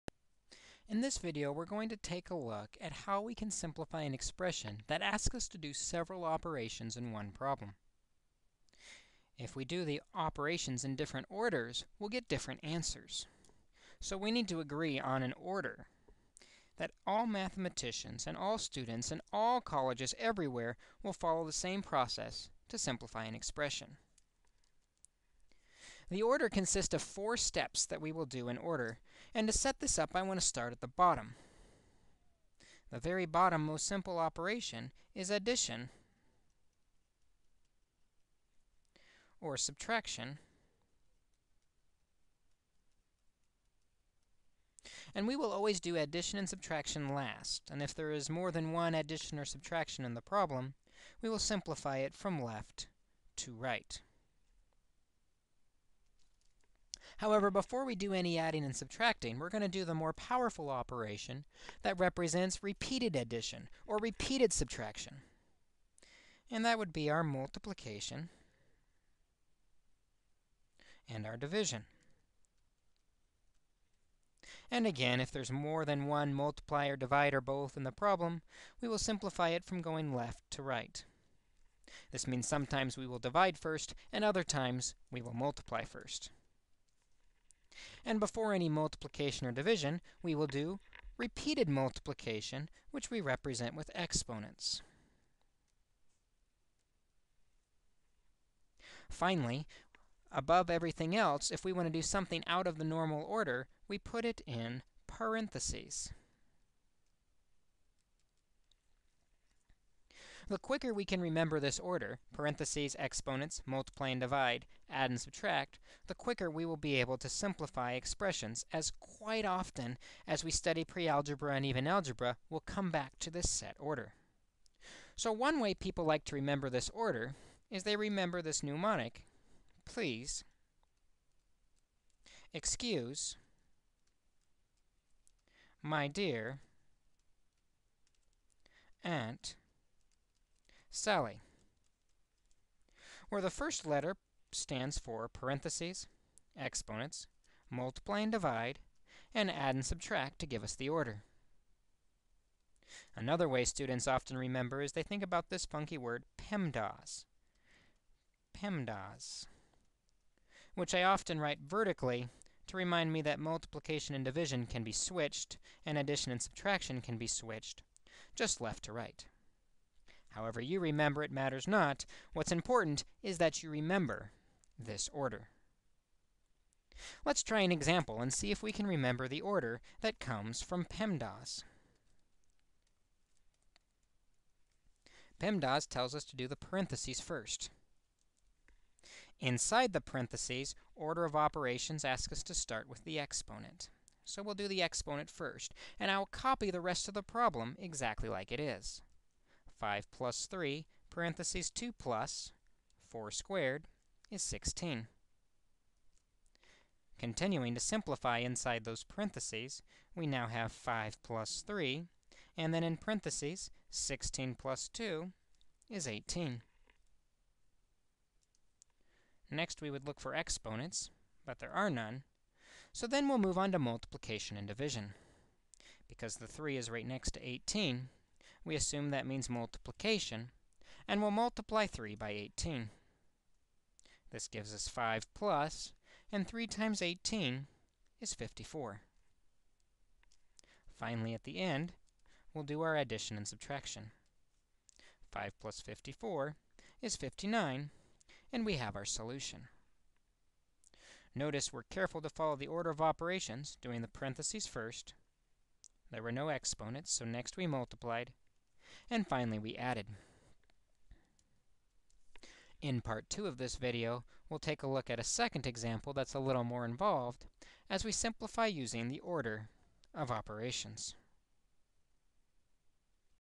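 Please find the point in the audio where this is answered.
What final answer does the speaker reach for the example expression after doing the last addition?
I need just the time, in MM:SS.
04:07.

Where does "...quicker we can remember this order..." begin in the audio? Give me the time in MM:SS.
01:50.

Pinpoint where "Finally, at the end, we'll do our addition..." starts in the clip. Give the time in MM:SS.
04:00.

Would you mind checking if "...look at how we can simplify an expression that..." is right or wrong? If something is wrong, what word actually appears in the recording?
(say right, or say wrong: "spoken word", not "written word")
right.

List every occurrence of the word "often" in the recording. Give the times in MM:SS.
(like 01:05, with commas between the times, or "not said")
01:59, 02:34, 02:41.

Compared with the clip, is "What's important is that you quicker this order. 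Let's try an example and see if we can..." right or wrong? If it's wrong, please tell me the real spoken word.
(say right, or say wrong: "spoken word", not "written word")
wrong: "remember", not "quicker".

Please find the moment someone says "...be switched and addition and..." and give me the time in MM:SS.
02:44.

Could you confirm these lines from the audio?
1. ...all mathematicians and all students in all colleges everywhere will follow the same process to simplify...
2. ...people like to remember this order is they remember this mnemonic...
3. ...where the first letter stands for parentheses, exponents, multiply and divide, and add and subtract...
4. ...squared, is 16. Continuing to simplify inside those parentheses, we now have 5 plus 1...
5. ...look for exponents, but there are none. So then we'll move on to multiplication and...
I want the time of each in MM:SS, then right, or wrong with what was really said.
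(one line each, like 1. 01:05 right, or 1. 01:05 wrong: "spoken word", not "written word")
1. 00:17 right
2. 02:05 right
3. 02:23 right
4. 03:23 wrong: "3", not "1"
5. 03:40 right.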